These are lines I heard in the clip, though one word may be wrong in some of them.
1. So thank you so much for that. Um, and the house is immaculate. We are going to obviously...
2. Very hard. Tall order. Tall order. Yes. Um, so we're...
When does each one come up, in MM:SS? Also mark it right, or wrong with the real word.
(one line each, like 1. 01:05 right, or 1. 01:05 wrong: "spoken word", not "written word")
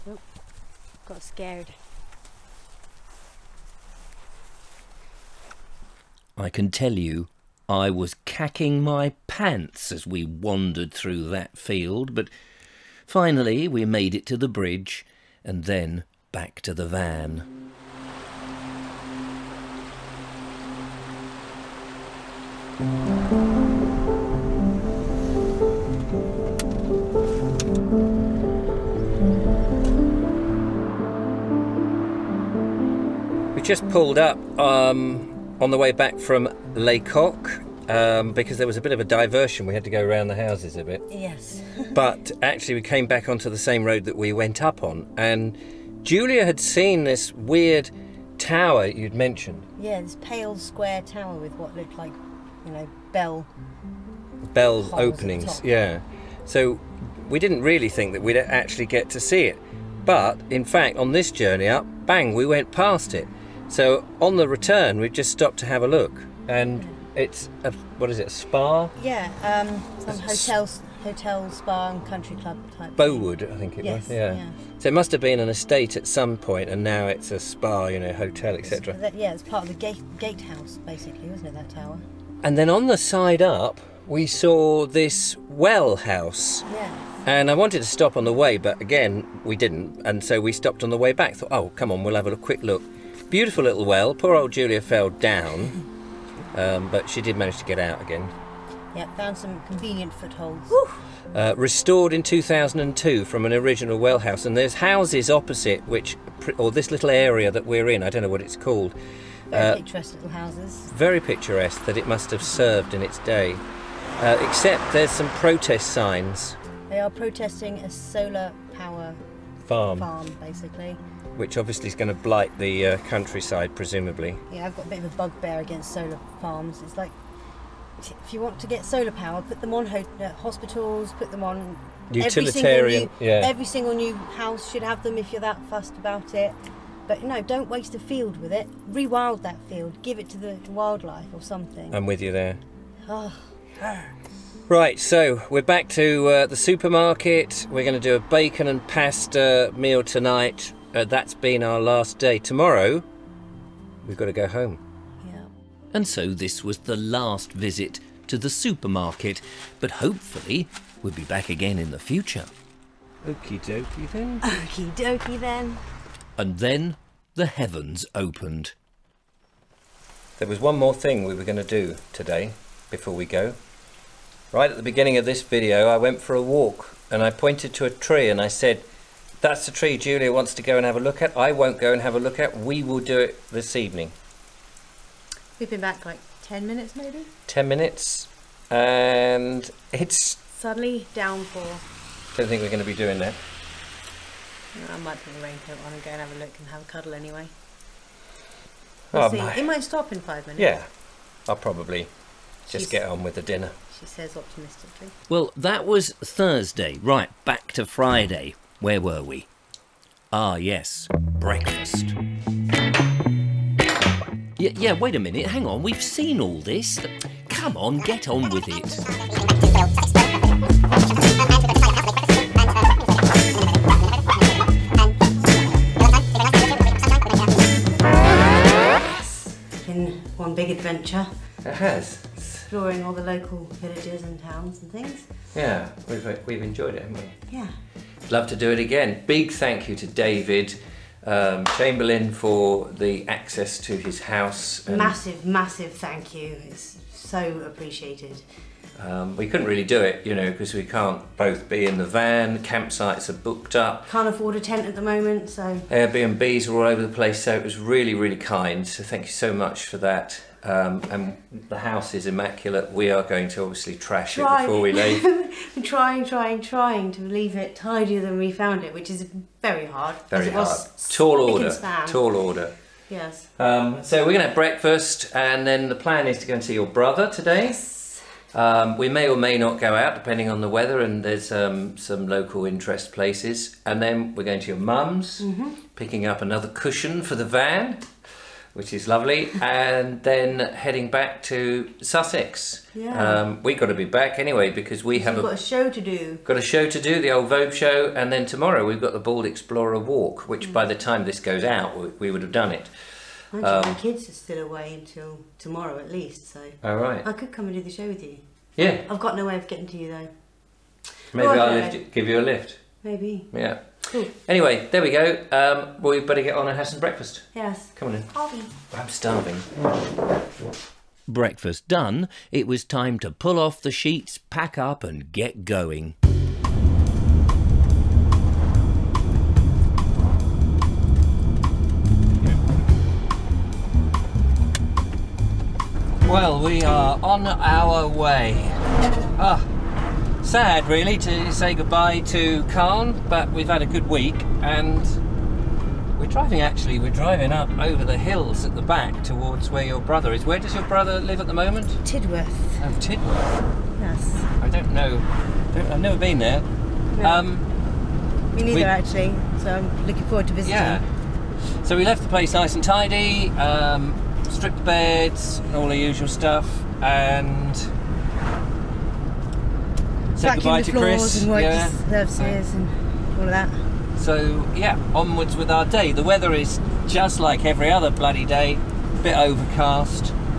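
1. 04:18 right
2. 04:30 right.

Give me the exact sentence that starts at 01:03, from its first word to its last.
So on the return, we just stopped to have a look.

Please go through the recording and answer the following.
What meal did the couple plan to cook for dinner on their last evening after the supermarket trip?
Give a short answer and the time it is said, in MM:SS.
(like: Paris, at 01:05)
Bacon and pasta, at 02:28.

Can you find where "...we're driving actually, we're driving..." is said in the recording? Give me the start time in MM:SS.
05:46.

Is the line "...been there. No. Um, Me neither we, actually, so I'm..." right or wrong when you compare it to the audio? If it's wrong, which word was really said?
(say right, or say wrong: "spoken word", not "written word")
right.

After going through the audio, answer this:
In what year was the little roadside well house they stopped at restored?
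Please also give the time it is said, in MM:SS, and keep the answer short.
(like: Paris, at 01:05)
2002, at 01:42.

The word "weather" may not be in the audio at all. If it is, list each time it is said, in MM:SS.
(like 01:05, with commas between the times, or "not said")
04:40, 06:16.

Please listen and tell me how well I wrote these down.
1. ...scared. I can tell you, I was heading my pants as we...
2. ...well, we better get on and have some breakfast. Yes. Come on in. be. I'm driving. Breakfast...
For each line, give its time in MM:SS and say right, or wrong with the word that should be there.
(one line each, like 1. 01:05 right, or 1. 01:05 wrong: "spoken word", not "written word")
1. 00:01 wrong: "cacking", not "heading"
2. 05:16 wrong: "starving", not "driving".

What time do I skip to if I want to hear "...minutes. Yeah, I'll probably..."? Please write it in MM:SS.
03:20.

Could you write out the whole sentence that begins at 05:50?
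Where does your brother live at the moment?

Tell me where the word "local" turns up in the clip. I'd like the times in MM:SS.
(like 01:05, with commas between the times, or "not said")
03:53, 04:42.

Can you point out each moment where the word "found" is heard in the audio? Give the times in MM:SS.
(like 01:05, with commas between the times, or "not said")
01:39, 04:28.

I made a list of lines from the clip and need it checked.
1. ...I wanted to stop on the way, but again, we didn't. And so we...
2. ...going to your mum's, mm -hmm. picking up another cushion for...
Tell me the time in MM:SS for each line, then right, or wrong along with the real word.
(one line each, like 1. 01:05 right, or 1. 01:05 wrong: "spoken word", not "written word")
1. 01:27 right
2. 04:44 right.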